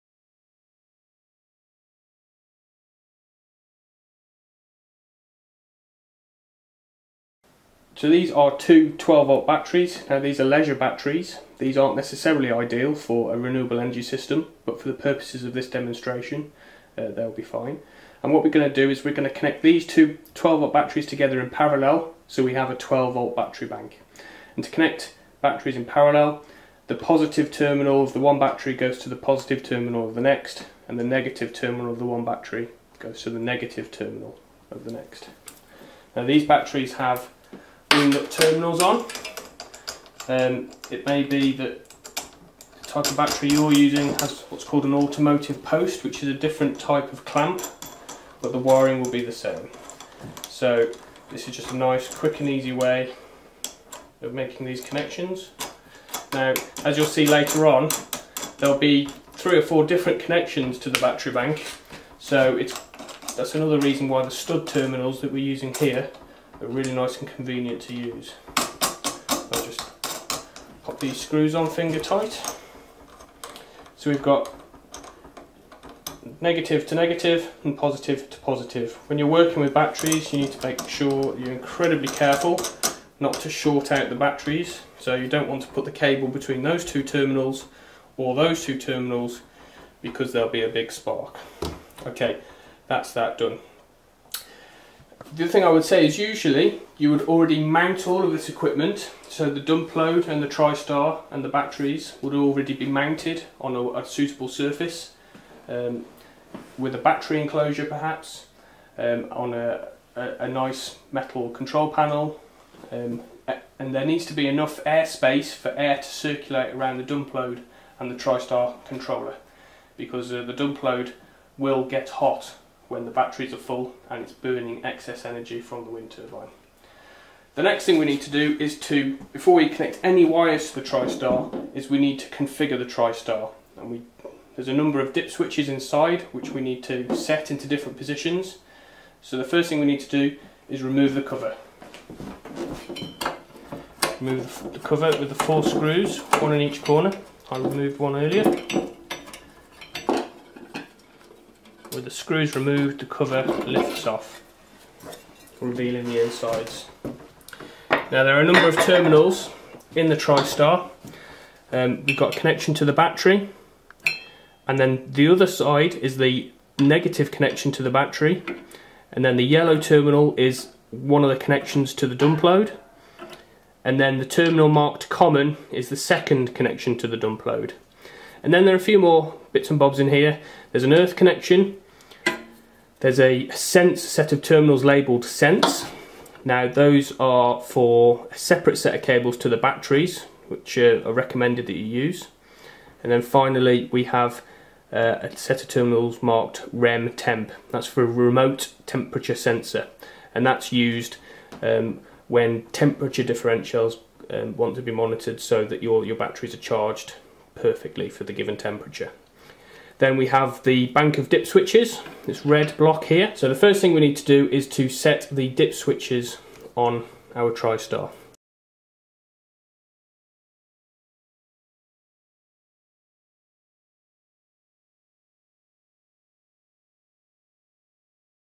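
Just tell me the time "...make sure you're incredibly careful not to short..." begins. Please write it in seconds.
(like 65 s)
80 s.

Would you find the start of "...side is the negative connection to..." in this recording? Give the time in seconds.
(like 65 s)
165 s.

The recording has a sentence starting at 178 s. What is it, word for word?
And then there are a few more bits and bobs in here.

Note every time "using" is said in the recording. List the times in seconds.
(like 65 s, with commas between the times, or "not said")
43 s, 65 s.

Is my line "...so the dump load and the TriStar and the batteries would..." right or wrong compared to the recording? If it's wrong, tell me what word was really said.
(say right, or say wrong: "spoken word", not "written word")
right.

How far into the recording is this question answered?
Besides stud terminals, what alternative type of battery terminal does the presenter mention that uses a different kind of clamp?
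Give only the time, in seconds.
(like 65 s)
44 s.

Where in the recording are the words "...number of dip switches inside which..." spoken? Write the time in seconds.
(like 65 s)
134 s.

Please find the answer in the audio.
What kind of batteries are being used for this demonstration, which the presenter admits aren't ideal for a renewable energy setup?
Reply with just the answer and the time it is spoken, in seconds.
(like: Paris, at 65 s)
Leisure batteries, at 10 s.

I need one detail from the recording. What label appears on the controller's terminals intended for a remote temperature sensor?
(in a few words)
REM temp.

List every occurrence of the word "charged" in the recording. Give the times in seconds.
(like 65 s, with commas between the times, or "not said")
206 s.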